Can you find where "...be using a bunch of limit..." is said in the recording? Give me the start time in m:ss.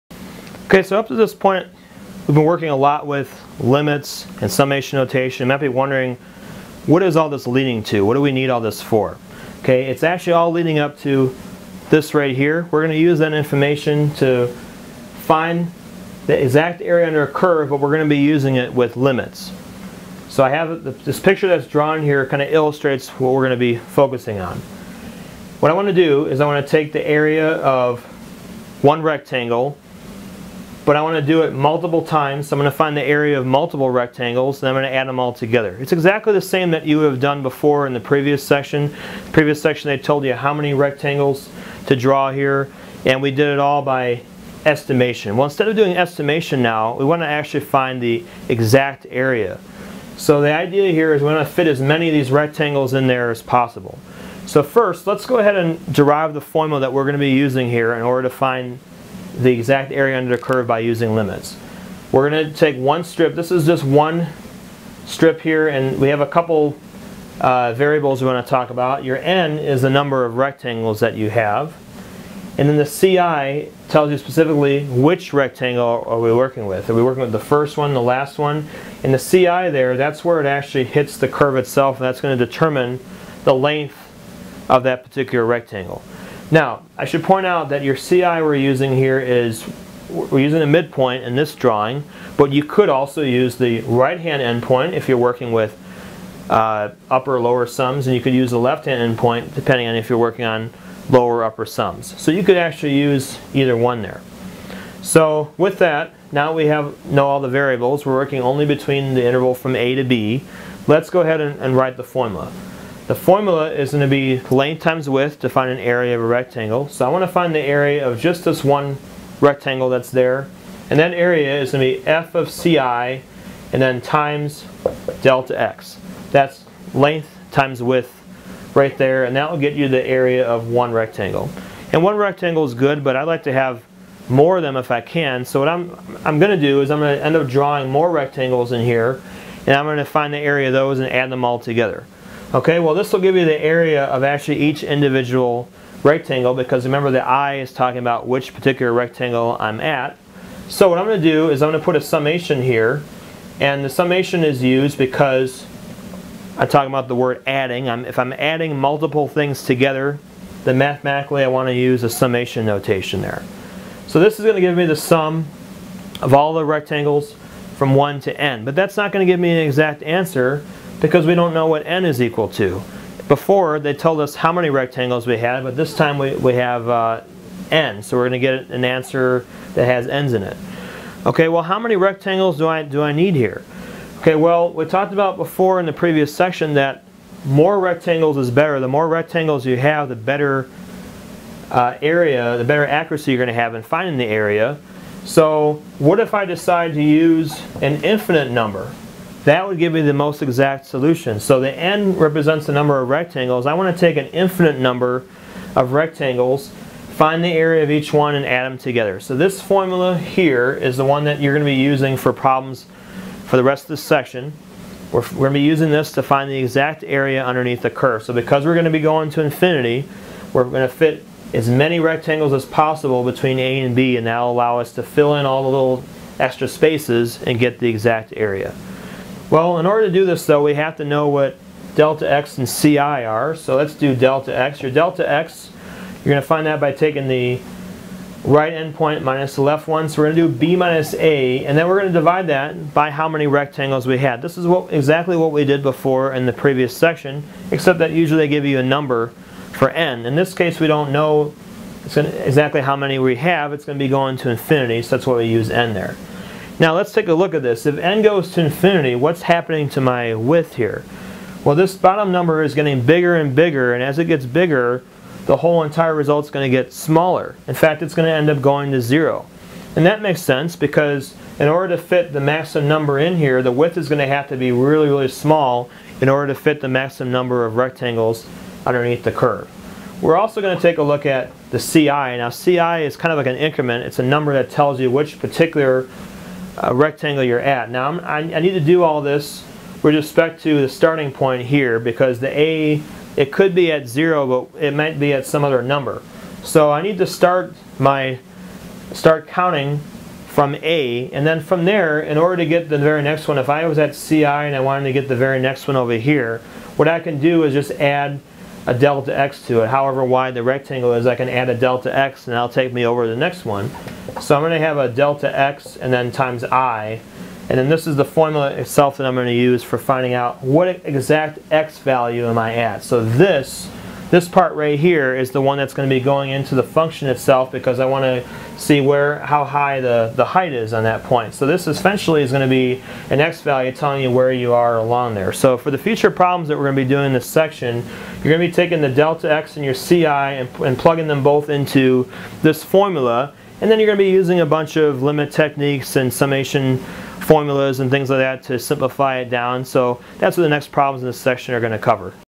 5:44.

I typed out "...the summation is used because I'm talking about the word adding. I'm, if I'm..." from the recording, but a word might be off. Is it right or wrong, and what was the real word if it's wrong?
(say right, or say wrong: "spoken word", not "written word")
right.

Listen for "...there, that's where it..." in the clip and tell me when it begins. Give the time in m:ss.
1:19.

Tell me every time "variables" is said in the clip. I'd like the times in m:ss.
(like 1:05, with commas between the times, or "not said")
1:07, 1:47.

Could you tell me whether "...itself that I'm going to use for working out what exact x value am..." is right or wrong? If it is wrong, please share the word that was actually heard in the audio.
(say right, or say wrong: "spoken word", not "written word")
wrong: "finding", not "working".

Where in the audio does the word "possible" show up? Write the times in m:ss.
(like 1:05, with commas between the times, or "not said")
0:53, 3:42.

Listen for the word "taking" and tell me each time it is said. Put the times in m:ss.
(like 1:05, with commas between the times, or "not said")
3:56, 5:38.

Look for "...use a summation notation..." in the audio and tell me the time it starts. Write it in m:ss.
2:41.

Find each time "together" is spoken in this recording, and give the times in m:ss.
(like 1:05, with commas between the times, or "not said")
0:35, 2:21, 2:39, 3:28.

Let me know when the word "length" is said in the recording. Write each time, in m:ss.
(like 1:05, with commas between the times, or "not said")
1:23, 1:54, 2:06.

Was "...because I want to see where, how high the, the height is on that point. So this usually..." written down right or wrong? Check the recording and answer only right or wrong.
wrong.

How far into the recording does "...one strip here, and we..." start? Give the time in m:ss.
1:03.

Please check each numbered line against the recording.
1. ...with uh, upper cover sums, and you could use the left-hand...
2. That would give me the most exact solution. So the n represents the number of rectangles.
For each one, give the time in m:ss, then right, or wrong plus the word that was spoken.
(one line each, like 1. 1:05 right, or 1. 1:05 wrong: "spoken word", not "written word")
1. 1:35 wrong: "lower", not "cover"
2. 3:19 right.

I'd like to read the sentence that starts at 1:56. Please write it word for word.
So I want to find the area of just this one rectangle that's there.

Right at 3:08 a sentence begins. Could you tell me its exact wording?
The more rectangles you have, the better uh, area, the better accuracy you're going to have in finding the area.